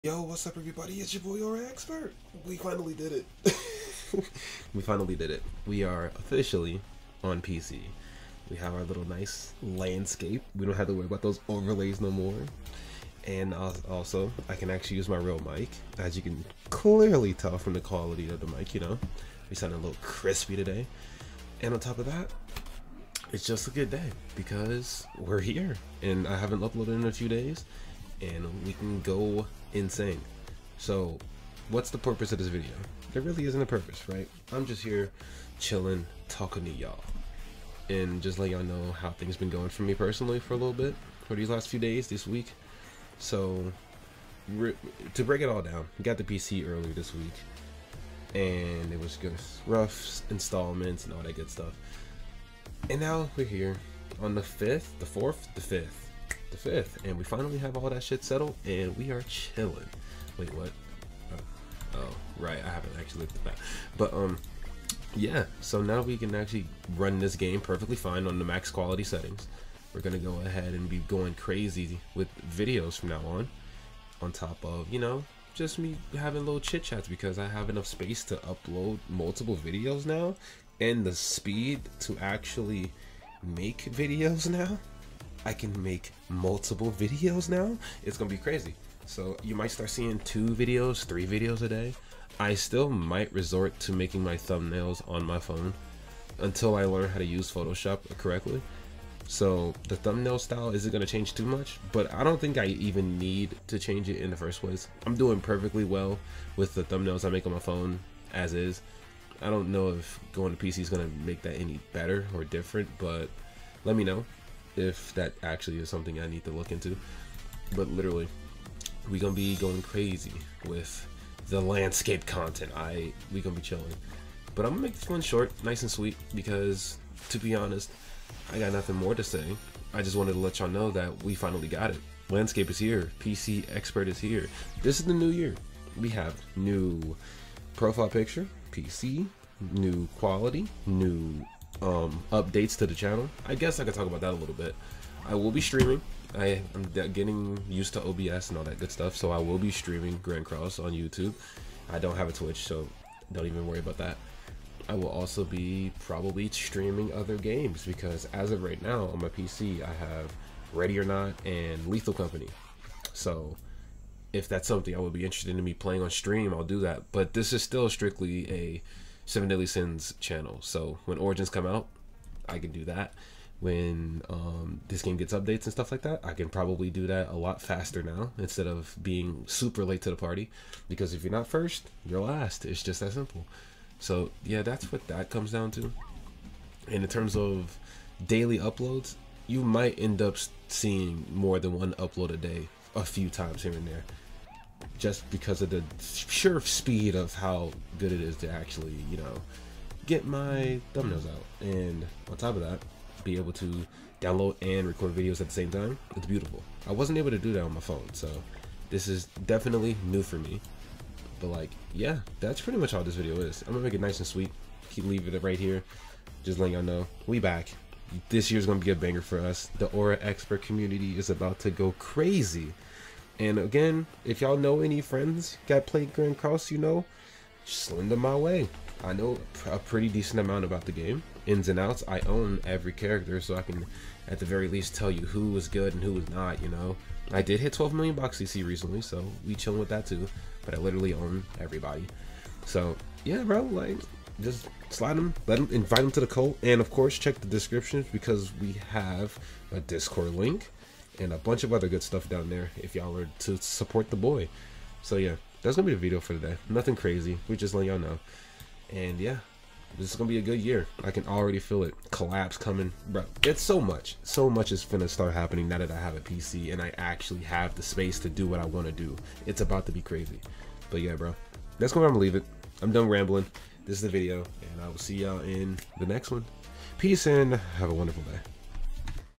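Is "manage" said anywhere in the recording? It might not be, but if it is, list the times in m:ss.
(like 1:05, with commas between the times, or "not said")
not said.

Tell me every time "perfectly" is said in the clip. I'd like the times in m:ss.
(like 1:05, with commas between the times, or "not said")
1:07, 1:45.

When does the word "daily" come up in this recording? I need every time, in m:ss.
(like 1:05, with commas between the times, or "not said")
3:08.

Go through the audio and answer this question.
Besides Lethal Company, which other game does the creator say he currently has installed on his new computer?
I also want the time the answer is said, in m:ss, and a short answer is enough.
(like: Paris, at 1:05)
Ready or Not, at 2:40.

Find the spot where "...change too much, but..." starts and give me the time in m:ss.
1:41.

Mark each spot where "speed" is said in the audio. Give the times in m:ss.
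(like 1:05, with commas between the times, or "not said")
1:21, 3:16.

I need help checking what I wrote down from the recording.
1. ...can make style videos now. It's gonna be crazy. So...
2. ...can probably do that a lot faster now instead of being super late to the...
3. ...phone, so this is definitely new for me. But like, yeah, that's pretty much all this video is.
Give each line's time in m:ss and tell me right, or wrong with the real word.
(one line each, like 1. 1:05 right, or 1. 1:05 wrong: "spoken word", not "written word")
1. 1:25 wrong: "multiple", not "style"
2. 2:56 right
3. 3:27 right.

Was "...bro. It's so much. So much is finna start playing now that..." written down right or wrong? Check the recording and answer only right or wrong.
wrong.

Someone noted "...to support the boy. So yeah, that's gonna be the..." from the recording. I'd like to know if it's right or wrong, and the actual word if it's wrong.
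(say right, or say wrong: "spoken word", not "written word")
right.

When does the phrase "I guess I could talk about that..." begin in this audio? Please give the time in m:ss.
2:23.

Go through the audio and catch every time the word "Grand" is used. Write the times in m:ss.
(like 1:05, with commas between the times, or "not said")
2:30, 3:46.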